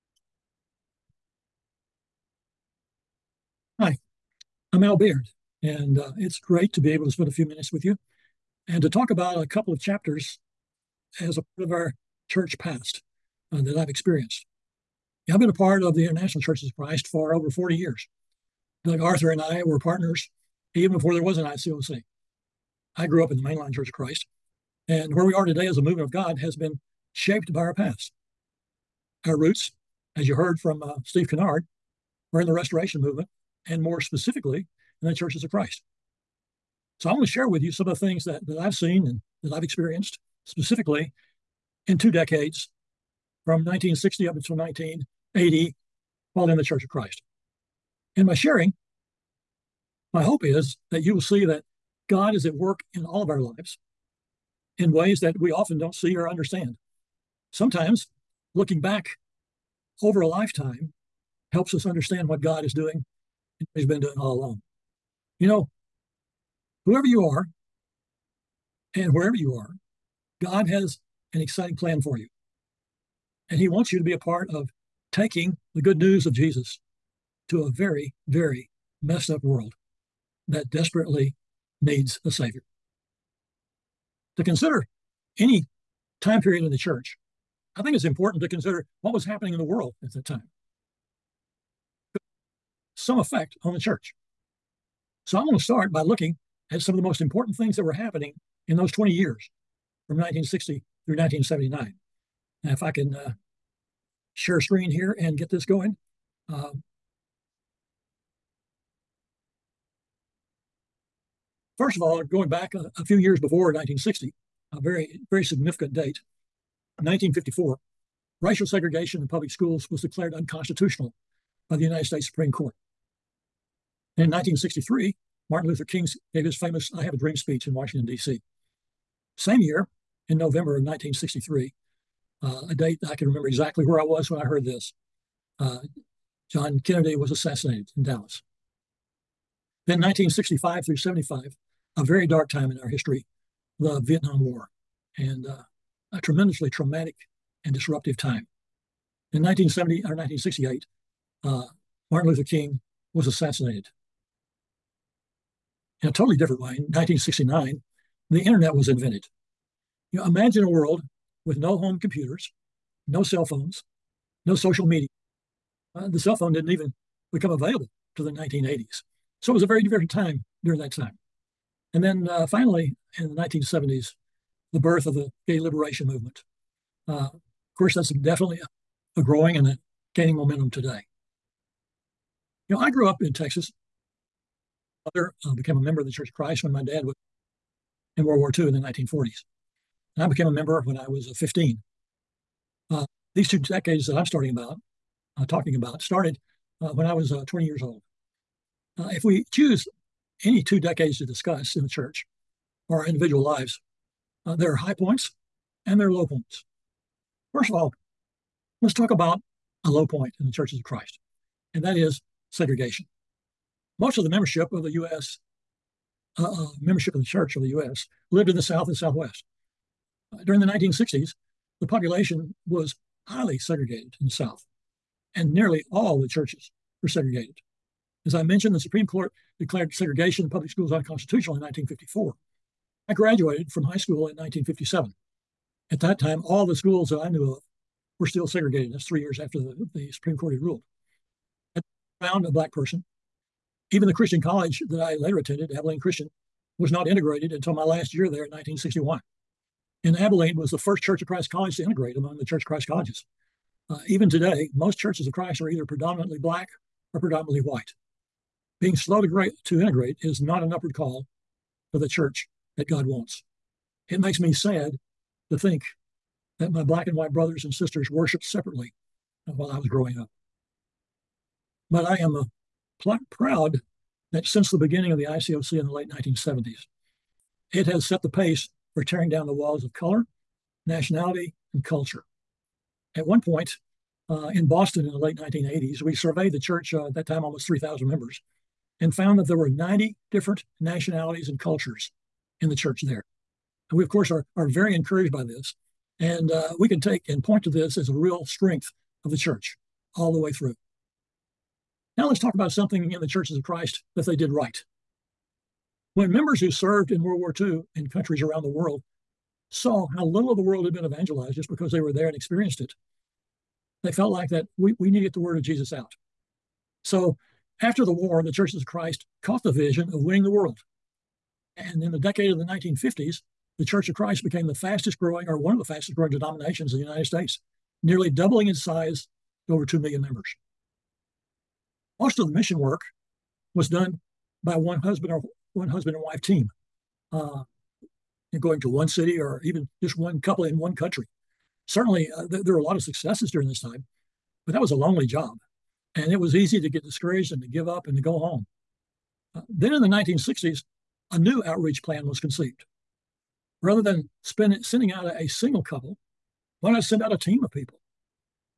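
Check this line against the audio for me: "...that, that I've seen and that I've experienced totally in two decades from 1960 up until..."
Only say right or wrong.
wrong.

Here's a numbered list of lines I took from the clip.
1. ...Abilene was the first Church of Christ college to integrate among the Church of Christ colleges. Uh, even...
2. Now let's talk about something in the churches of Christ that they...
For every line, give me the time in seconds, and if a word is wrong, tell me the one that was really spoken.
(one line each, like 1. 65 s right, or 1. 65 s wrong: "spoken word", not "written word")
1. 250 s right
2. 302 s right.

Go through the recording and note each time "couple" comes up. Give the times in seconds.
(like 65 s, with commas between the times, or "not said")
9 s, 340 s, 355 s.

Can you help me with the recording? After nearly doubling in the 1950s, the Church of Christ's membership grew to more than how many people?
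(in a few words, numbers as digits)
2 million.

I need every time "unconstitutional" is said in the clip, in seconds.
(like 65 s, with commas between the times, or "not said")
120 s, 230 s.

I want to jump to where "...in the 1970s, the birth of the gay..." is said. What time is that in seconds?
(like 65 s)
173 s.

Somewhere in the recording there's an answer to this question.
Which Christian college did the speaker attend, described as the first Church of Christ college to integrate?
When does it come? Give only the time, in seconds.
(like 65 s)
245 s.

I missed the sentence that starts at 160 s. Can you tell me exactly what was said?
You know, imagine a world with no home computers, no cell phones, no social media.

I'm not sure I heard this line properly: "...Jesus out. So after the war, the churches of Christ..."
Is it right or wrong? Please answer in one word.
right.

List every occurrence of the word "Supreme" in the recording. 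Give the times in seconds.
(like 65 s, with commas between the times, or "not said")
122 s, 228 s, 240 s.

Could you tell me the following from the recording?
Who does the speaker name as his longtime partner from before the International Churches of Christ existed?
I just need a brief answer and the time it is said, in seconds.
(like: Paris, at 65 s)
Doug Arthur, at 18 s.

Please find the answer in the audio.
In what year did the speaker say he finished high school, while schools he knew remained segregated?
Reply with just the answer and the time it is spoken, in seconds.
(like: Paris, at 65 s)
1957, at 234 s.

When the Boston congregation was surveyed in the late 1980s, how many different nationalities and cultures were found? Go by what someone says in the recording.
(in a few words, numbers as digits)
90.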